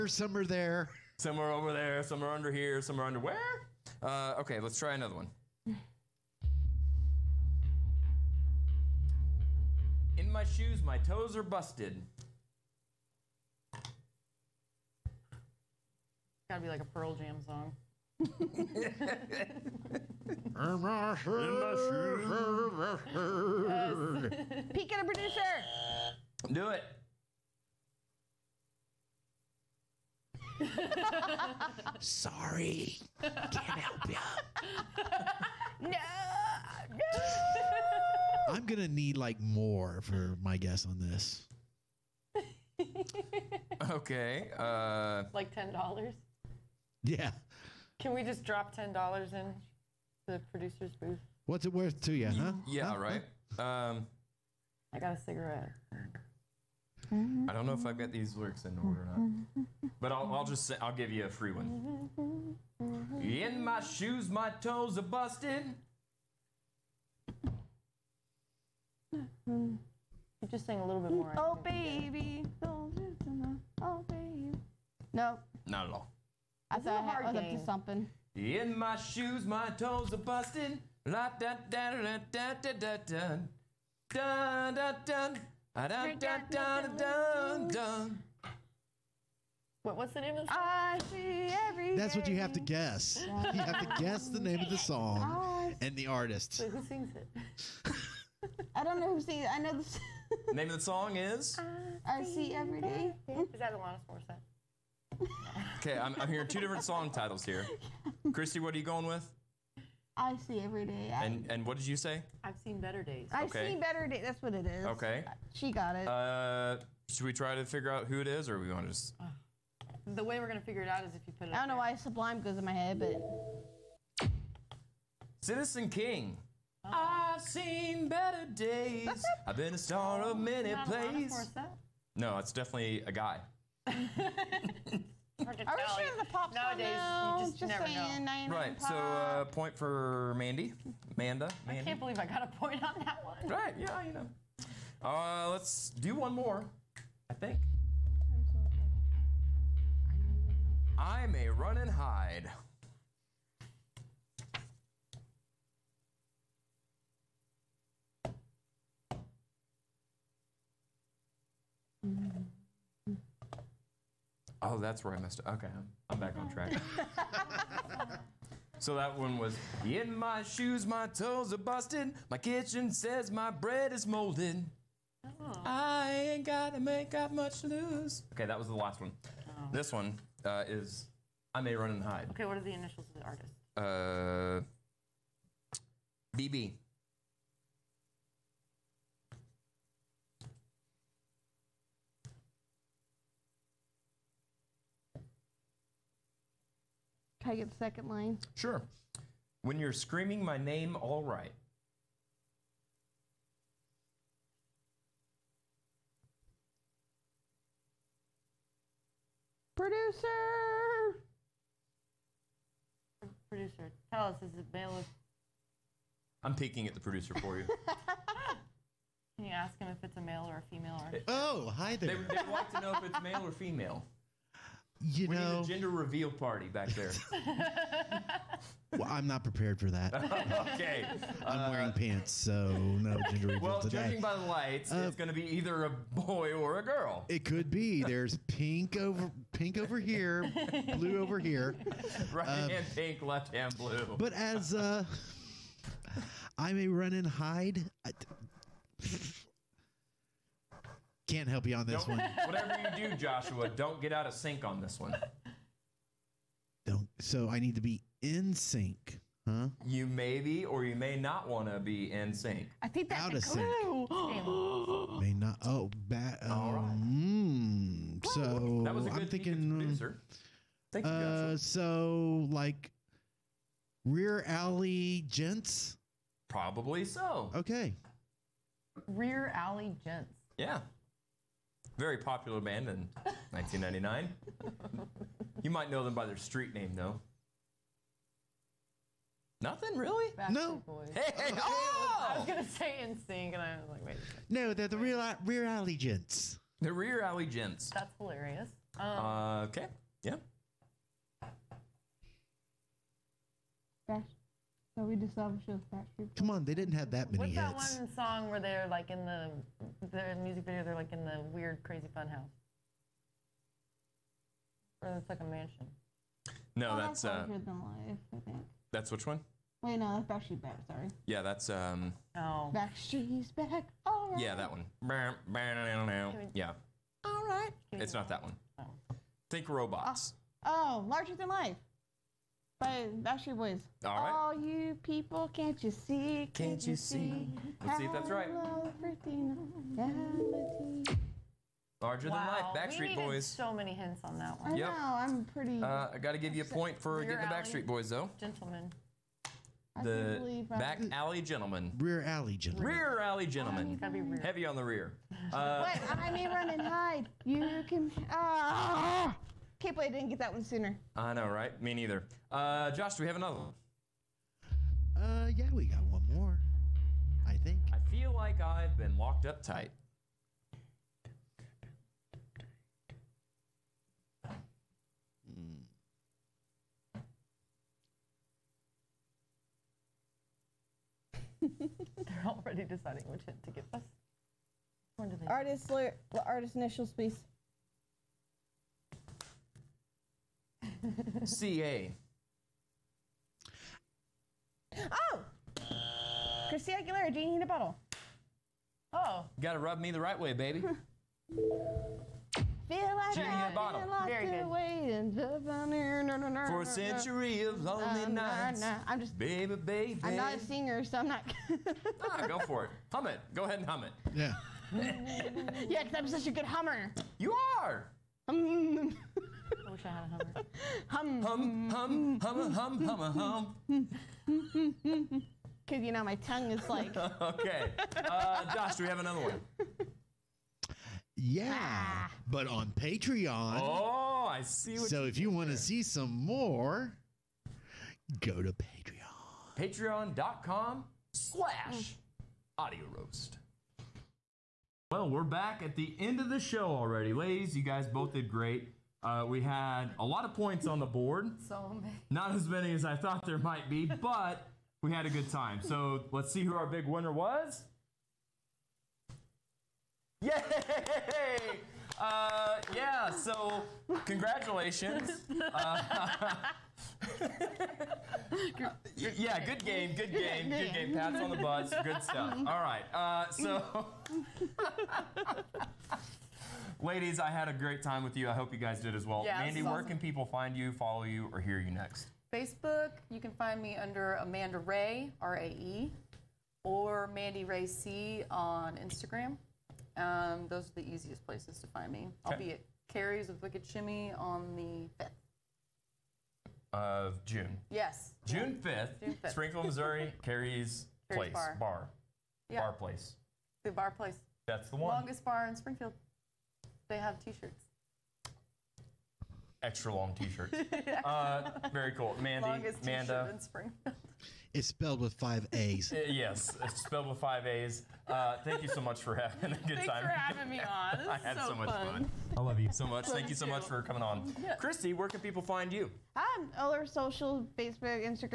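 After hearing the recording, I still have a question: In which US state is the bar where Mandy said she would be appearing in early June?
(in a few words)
Missouri.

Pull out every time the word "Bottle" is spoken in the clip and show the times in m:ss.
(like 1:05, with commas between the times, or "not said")
6:37.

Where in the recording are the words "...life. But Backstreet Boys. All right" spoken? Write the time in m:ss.
5:31.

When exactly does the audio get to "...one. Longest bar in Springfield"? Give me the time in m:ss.
8:24.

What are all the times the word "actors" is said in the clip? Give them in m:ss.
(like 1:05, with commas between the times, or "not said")
not said.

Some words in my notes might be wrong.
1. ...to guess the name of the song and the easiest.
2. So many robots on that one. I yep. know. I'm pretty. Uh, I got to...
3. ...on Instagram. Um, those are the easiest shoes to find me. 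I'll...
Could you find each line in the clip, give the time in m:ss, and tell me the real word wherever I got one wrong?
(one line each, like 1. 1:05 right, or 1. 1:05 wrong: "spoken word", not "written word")
1. 1:33 wrong: "artist", not "easiest"
2. 5:43 wrong: "hints", not "robots"
3. 8:08 wrong: "places", not "shoes".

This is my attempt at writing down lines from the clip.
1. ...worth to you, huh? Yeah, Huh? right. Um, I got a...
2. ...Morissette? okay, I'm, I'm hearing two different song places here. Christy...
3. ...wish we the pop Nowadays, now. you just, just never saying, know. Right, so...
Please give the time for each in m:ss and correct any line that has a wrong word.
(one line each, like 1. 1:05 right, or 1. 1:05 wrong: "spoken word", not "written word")
1. 0:51 right
2. 1:44 wrong: "titles", not "places"
3. 2:15 right.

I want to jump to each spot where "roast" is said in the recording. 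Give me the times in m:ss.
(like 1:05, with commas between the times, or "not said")
7:23.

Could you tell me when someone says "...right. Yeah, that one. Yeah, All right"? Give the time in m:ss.
5:24.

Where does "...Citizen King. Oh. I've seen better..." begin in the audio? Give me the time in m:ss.
2:05.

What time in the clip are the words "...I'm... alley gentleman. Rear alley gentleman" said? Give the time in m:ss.
5:51.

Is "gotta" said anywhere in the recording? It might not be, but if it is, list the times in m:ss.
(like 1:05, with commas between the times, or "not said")
0:16, 2:56, 6:39.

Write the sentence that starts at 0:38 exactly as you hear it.
I'm gonna need like more for my guess on this.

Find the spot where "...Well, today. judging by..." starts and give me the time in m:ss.
3:53.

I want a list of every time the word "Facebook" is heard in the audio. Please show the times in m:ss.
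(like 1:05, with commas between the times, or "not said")
8:02, 8:47.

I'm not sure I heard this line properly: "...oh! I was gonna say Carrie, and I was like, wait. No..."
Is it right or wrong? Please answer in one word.
wrong.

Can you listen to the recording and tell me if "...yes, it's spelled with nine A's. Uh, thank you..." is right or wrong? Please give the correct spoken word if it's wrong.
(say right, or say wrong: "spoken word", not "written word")
wrong: "five", not "nine".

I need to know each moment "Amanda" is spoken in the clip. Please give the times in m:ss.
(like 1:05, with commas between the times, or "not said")
8:04, 8:33.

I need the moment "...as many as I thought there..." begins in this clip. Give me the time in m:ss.
7:32.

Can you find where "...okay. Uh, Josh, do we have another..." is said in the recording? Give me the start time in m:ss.
7:07.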